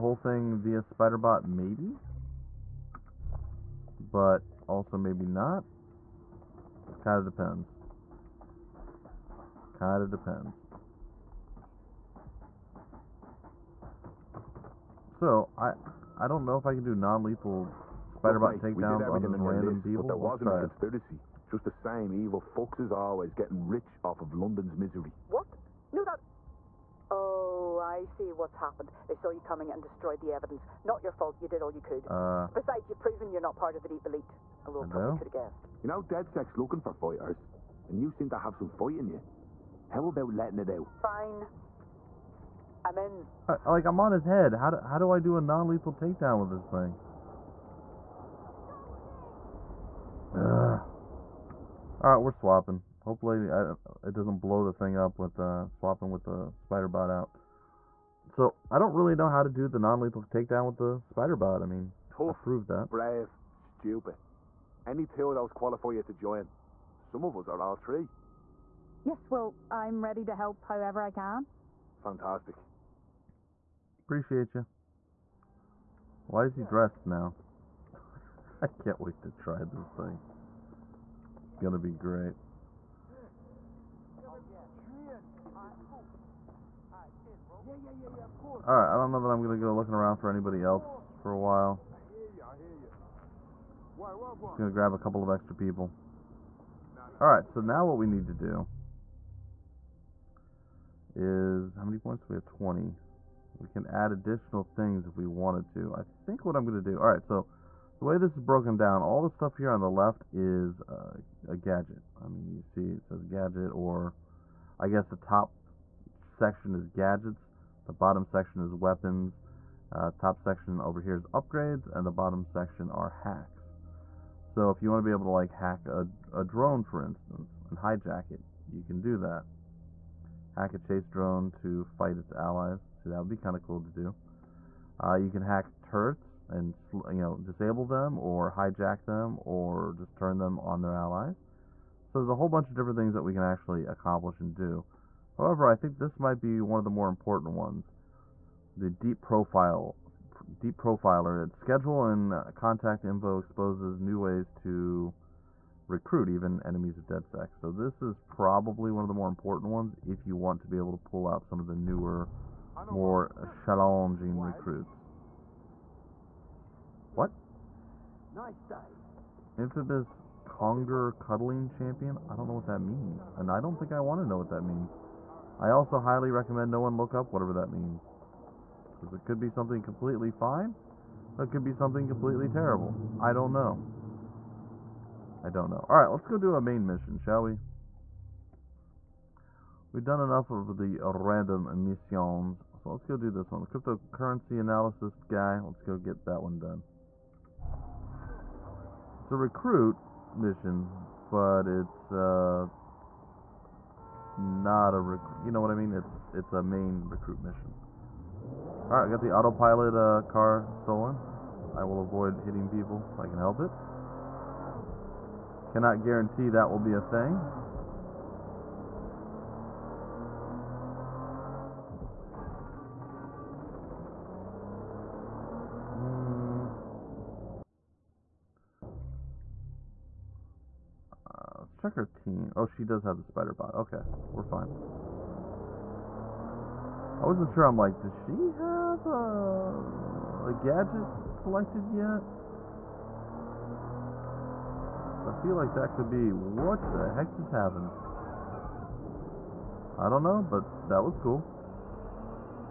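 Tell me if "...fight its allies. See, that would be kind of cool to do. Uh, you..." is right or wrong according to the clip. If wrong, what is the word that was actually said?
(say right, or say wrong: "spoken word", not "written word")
right.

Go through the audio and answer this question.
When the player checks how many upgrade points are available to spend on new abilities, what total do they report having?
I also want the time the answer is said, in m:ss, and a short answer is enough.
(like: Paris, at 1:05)
20, at 1:42.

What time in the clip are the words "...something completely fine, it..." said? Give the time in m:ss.
2:59.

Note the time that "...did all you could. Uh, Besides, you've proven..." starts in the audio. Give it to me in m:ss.
0:31.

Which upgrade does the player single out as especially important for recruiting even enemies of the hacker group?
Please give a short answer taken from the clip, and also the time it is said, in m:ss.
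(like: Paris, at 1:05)
deep profiler, at 2:30.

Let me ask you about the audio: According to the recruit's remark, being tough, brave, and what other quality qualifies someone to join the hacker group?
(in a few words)
stupid.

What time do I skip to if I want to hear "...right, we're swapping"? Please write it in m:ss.
0:52.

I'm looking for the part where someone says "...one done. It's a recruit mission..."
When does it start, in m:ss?
3:16.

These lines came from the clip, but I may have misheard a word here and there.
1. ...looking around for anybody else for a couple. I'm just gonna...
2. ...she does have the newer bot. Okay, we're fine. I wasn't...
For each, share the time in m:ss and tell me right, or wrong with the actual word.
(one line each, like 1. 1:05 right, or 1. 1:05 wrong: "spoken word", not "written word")
1. 1:29 wrong: "while", not "couple"
2. 3:52 wrong: "spider", not "newer".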